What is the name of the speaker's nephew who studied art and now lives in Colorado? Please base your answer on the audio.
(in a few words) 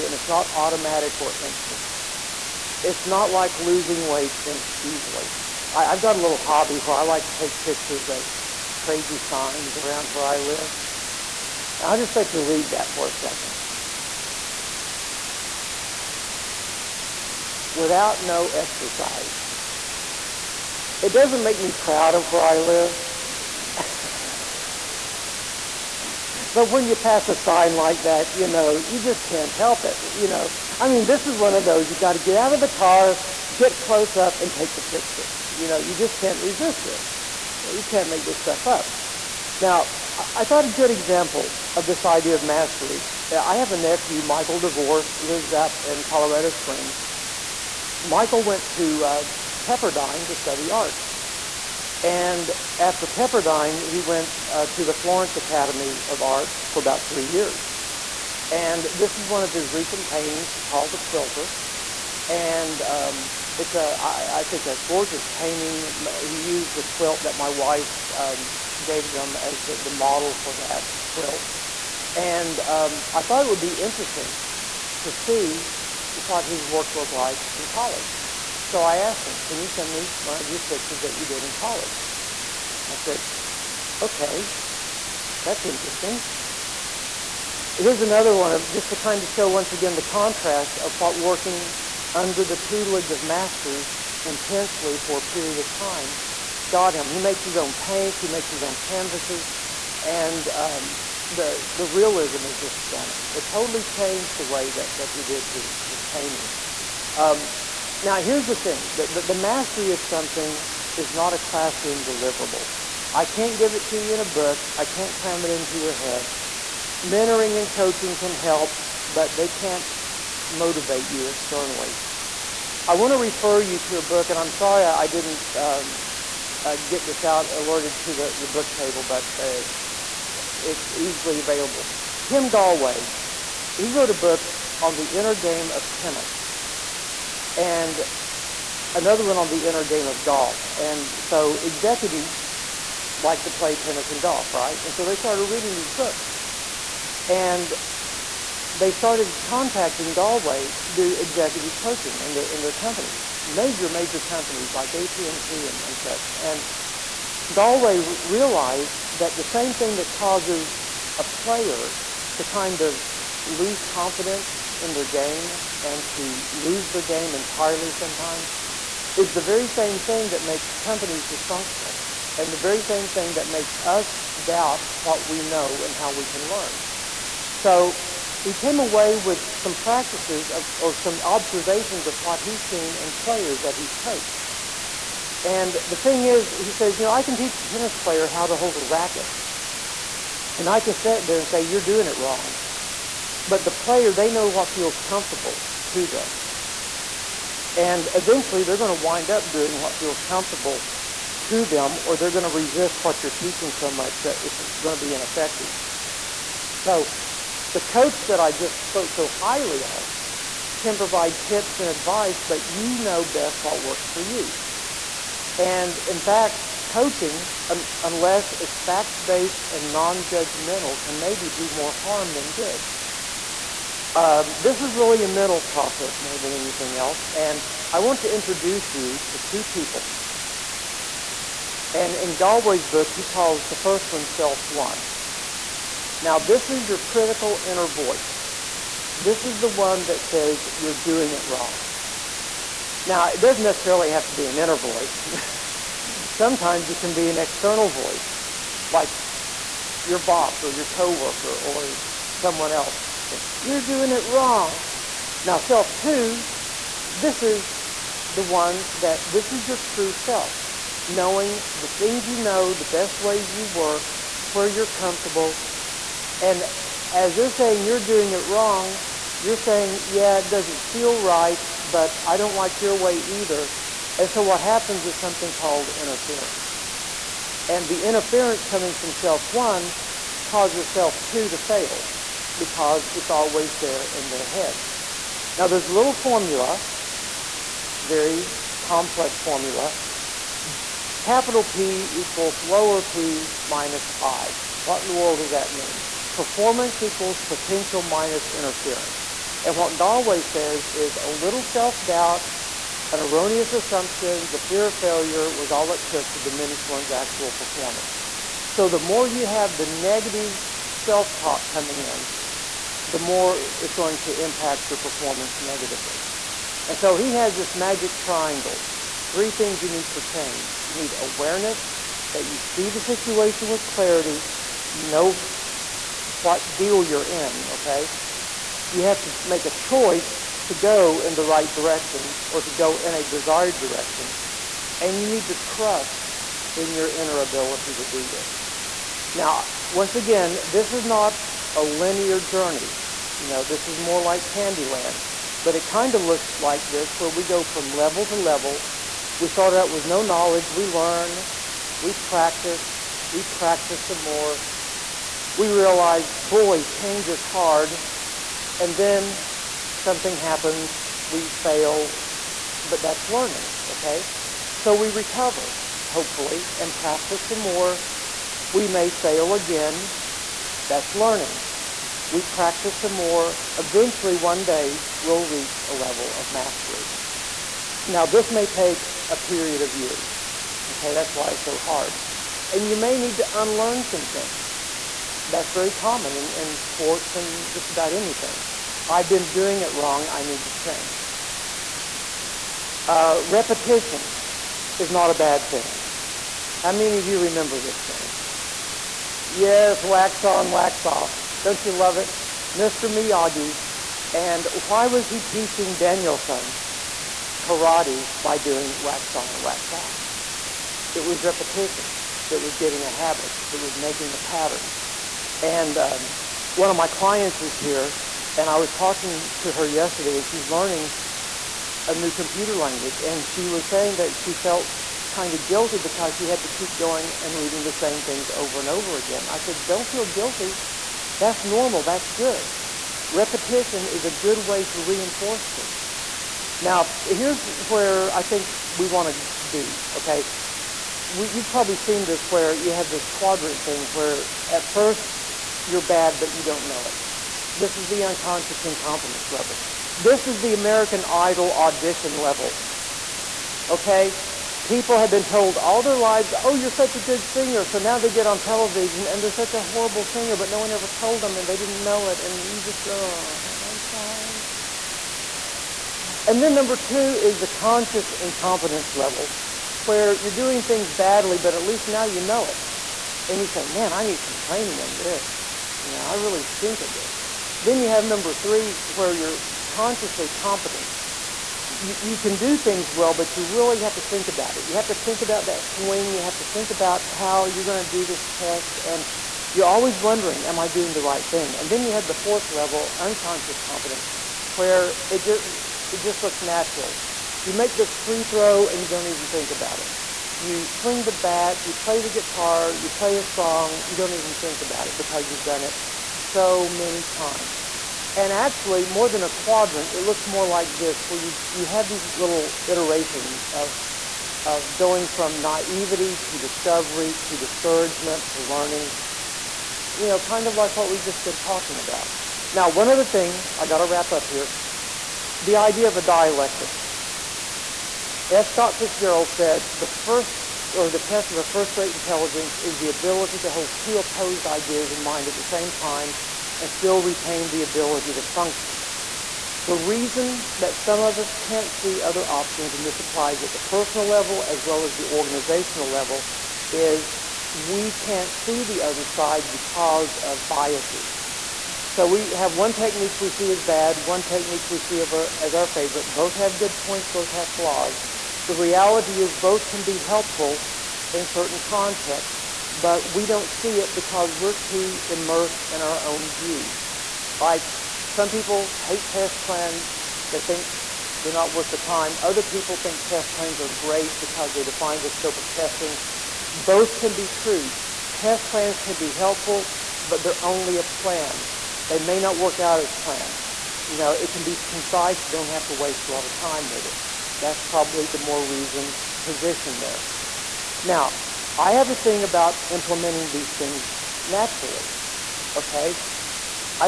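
Michael DeVore.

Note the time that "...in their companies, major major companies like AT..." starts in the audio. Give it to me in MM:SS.
02:32.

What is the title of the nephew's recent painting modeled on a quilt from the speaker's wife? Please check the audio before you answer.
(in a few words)
The Quilter.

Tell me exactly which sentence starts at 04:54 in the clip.
What in the world does that mean?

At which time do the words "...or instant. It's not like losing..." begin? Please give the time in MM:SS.
00:01.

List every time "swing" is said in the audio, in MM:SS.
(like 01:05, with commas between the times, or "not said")
08:05, 08:20.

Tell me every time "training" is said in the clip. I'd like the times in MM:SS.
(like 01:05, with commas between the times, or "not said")
07:54.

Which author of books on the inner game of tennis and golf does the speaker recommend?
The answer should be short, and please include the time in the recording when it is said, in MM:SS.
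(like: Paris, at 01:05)
Tim Gallwey, at 02:12.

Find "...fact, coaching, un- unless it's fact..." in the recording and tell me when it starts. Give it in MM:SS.
03:36.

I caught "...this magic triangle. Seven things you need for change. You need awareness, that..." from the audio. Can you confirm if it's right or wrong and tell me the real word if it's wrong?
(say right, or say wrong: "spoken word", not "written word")
wrong: "Three", not "Seven".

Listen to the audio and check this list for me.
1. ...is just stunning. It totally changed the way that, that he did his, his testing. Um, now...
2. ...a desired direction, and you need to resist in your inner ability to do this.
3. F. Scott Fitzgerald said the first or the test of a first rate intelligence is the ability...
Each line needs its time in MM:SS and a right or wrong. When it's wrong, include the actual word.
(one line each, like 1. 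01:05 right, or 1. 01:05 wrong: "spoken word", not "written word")
1. 01:42 wrong: "painting", not "testing"
2. 05:33 wrong: "trust", not "resist"
3. 08:48 right.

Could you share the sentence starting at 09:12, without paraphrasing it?
So we have one technique we see as bad, one technique we see as our favorite.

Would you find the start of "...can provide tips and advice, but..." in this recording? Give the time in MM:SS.
03:30.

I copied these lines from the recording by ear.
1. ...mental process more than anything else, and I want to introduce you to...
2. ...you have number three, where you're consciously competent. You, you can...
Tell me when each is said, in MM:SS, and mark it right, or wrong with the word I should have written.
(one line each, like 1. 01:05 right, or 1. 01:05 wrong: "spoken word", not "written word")
1. 03:45 right
2. 07:57 right.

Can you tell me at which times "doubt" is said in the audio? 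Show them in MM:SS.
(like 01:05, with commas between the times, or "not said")
02:54, 05:02.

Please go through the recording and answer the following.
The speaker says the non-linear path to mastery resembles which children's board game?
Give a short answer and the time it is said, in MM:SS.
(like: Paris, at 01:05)
Candyland, at 05:44.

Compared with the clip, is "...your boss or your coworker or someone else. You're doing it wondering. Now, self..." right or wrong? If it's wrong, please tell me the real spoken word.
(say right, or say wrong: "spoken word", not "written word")
wrong: "wrong", not "wondering".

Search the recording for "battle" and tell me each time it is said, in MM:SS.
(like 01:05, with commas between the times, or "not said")
not said.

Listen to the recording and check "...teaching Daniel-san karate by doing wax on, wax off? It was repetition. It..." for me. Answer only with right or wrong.
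right.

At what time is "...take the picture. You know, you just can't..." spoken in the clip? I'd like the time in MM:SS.
00:34.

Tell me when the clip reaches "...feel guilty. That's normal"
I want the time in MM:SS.
07:10.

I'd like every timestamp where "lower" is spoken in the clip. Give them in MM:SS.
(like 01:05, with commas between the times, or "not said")
04:52.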